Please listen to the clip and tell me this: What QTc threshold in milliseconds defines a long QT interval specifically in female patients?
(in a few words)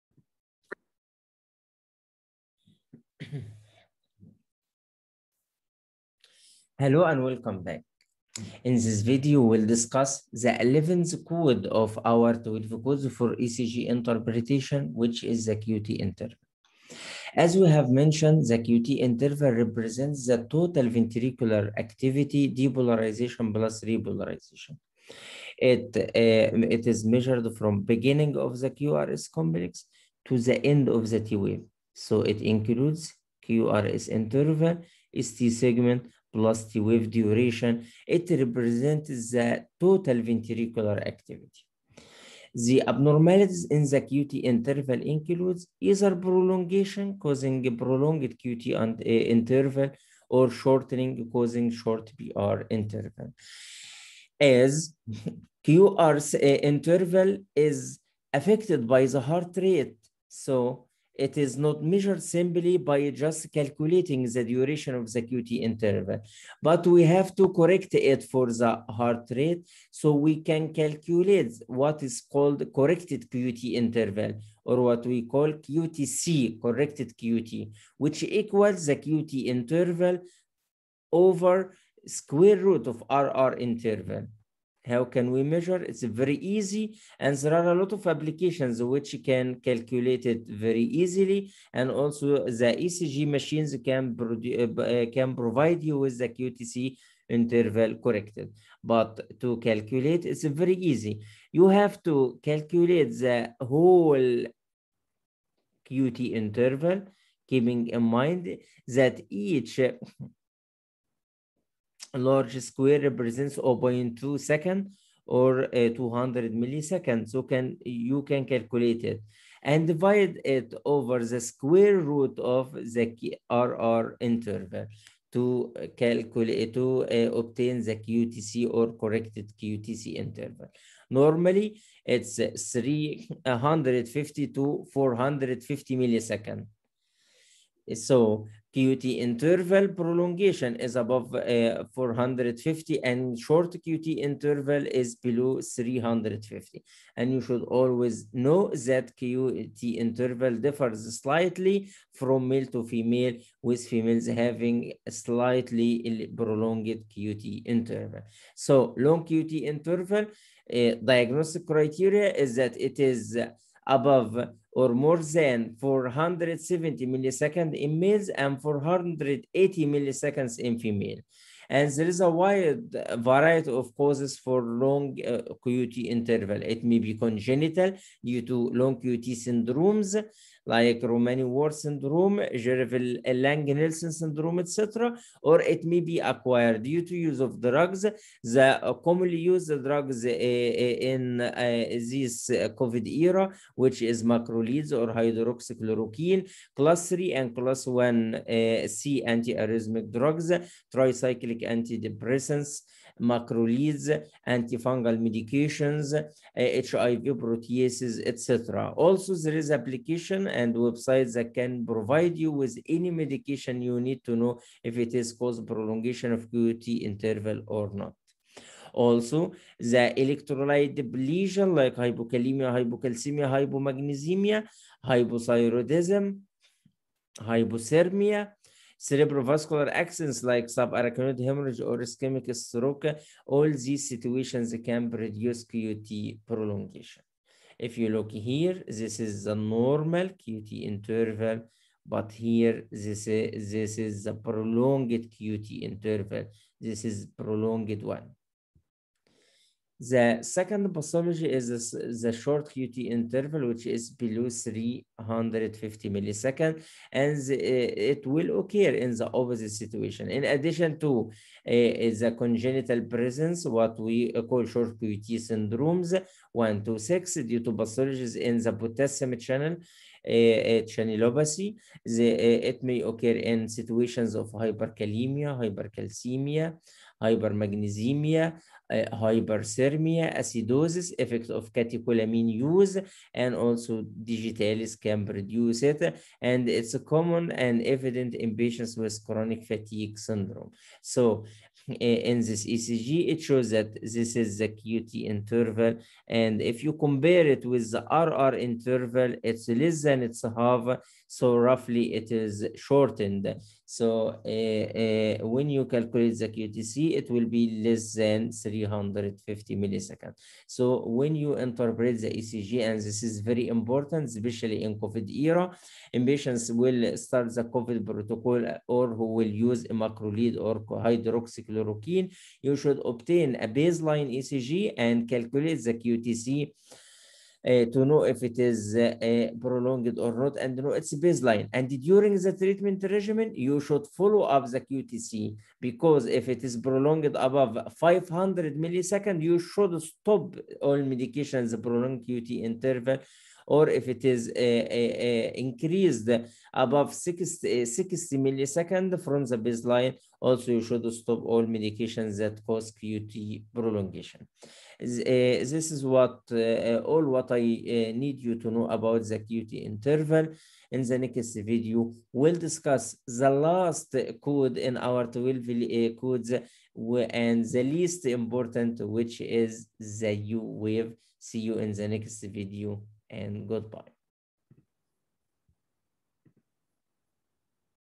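480 milliseconds.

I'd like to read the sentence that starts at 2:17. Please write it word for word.
So QT interval prolongation is above uh, 450 and short QT interval is below 350.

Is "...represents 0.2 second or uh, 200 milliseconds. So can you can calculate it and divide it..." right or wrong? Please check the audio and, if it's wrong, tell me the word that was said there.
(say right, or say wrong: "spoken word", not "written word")
right.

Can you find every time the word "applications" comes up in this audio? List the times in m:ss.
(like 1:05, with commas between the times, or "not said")
1:28, 3:29.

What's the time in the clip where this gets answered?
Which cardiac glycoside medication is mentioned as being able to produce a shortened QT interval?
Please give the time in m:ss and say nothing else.
4:44.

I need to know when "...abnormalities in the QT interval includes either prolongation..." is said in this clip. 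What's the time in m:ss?
0:42.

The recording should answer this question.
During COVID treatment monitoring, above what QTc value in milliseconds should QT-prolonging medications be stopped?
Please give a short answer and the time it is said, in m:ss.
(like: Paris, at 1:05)
500 milliseconds, at 5:37.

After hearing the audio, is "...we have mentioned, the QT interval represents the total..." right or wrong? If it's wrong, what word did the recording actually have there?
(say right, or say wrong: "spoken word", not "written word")
right.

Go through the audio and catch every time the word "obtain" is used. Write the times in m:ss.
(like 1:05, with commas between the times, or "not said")
2:07, 5:23.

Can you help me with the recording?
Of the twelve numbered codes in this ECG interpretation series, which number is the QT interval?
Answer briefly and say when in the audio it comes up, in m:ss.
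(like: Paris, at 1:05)
11th, at 0:10.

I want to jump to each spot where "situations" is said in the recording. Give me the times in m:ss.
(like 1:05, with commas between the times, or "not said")
3:54, 4:19, 4:33.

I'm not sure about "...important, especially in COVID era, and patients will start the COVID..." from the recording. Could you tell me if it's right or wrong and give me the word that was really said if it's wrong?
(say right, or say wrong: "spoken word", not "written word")
right.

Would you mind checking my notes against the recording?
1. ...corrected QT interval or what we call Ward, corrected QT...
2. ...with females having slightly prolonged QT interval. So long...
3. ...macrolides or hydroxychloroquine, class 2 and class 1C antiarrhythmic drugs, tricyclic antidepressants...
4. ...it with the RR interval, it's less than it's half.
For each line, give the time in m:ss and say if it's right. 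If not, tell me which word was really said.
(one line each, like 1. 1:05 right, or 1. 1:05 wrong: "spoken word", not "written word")
1. 1:12 wrong: "QTC", not "Ward"
2. 2:33 right
3. 3:14 wrong: "3", not "2"
4. 4:57 right.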